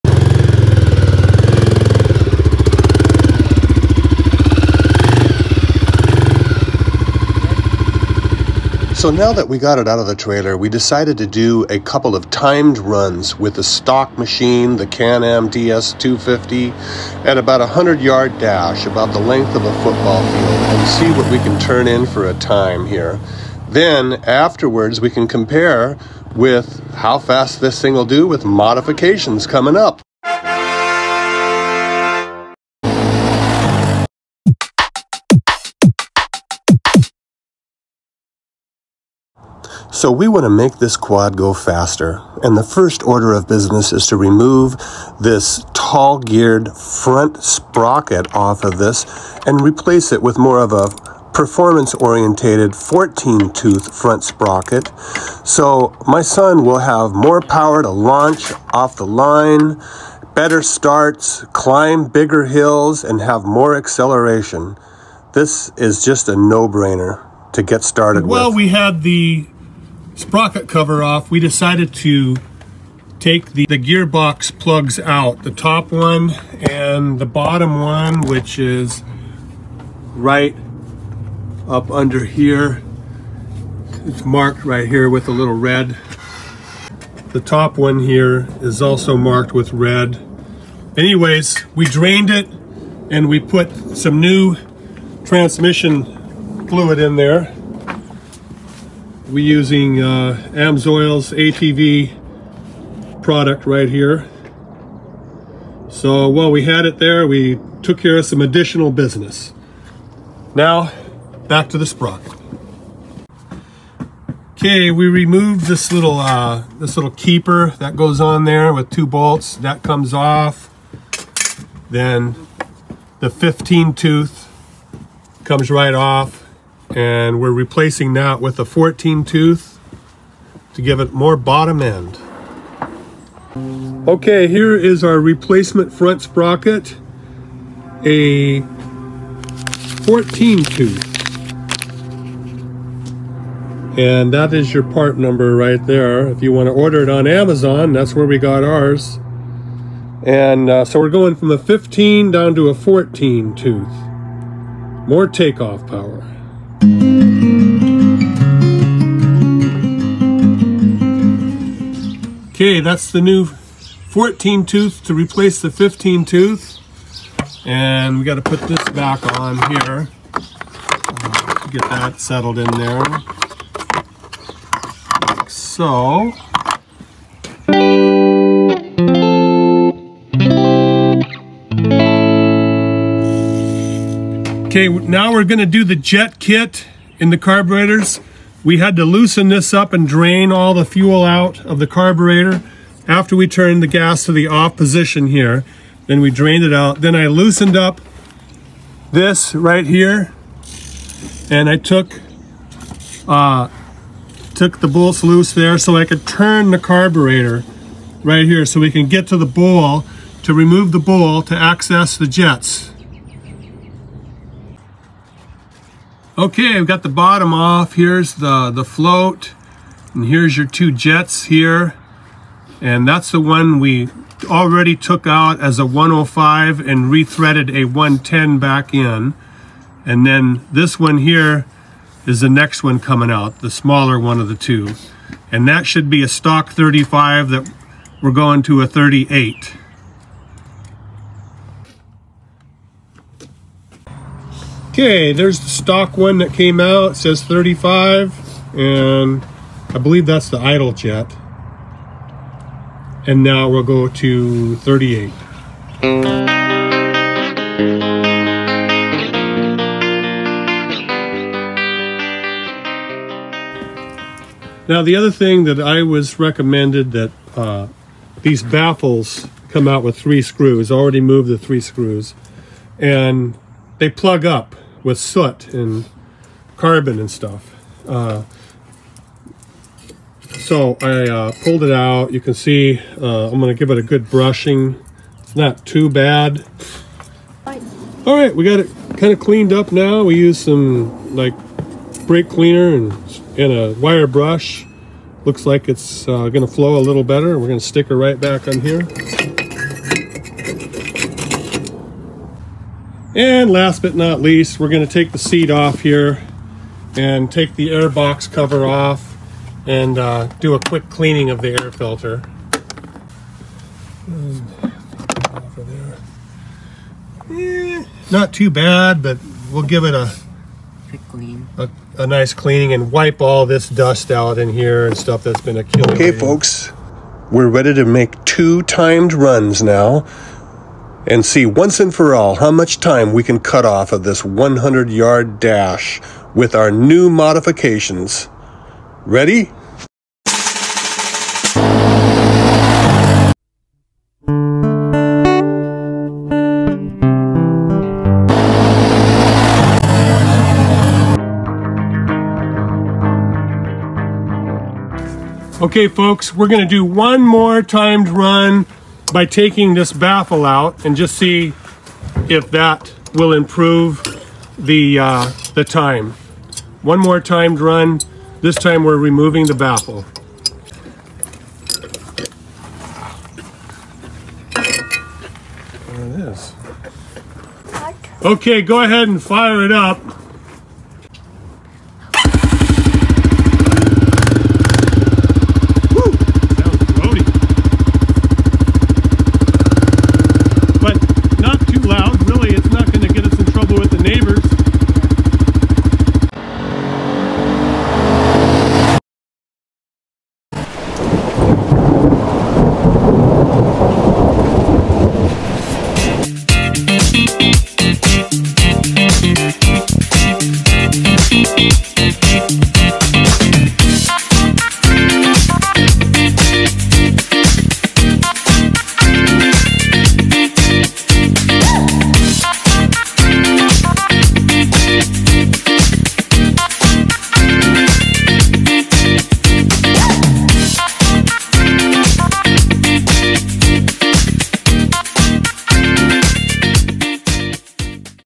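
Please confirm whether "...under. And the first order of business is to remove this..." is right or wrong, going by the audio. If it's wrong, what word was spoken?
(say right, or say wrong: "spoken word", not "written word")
wrong: "faster", not "under".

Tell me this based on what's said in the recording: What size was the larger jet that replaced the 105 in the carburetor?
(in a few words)
110.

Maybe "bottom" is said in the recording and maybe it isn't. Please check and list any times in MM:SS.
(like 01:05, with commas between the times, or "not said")
01:17, 02:11, 03:37.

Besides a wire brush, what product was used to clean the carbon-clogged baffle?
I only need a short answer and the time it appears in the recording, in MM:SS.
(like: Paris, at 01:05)
brake cleaner, at 04:52.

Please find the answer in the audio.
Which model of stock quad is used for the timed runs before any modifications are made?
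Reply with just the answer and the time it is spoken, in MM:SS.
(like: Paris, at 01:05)
Can-Am DS250, at 00:14.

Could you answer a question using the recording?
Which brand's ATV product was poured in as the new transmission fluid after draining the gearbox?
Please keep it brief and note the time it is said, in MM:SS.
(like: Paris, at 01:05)
Amsoil, at 01:40.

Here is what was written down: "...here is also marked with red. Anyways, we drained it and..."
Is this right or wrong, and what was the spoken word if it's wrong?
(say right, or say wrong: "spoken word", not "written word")
right.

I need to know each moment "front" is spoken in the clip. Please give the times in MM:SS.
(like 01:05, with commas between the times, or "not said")
00:46, 00:53, 02:15.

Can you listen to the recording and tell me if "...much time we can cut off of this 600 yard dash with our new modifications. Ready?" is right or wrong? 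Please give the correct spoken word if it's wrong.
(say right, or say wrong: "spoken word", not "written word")
wrong: "100", not "600".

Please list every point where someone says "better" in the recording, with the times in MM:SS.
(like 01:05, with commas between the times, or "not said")
01:00, 04:57.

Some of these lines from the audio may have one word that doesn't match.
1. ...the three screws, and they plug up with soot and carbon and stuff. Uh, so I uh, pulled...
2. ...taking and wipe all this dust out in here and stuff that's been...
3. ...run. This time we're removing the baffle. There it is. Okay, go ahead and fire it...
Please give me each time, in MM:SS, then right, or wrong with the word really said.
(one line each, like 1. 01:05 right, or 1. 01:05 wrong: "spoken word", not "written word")
1. 04:31 right
2. 05:22 wrong: "cleaning", not "taking"
3. 06:07 right.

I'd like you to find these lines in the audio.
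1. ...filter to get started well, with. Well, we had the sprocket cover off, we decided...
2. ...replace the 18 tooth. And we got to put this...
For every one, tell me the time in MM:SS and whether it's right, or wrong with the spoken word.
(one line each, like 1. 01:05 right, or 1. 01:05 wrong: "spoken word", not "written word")
1. 01:06 wrong: "brainer", not "filter"
2. 02:45 wrong: "15", not "18".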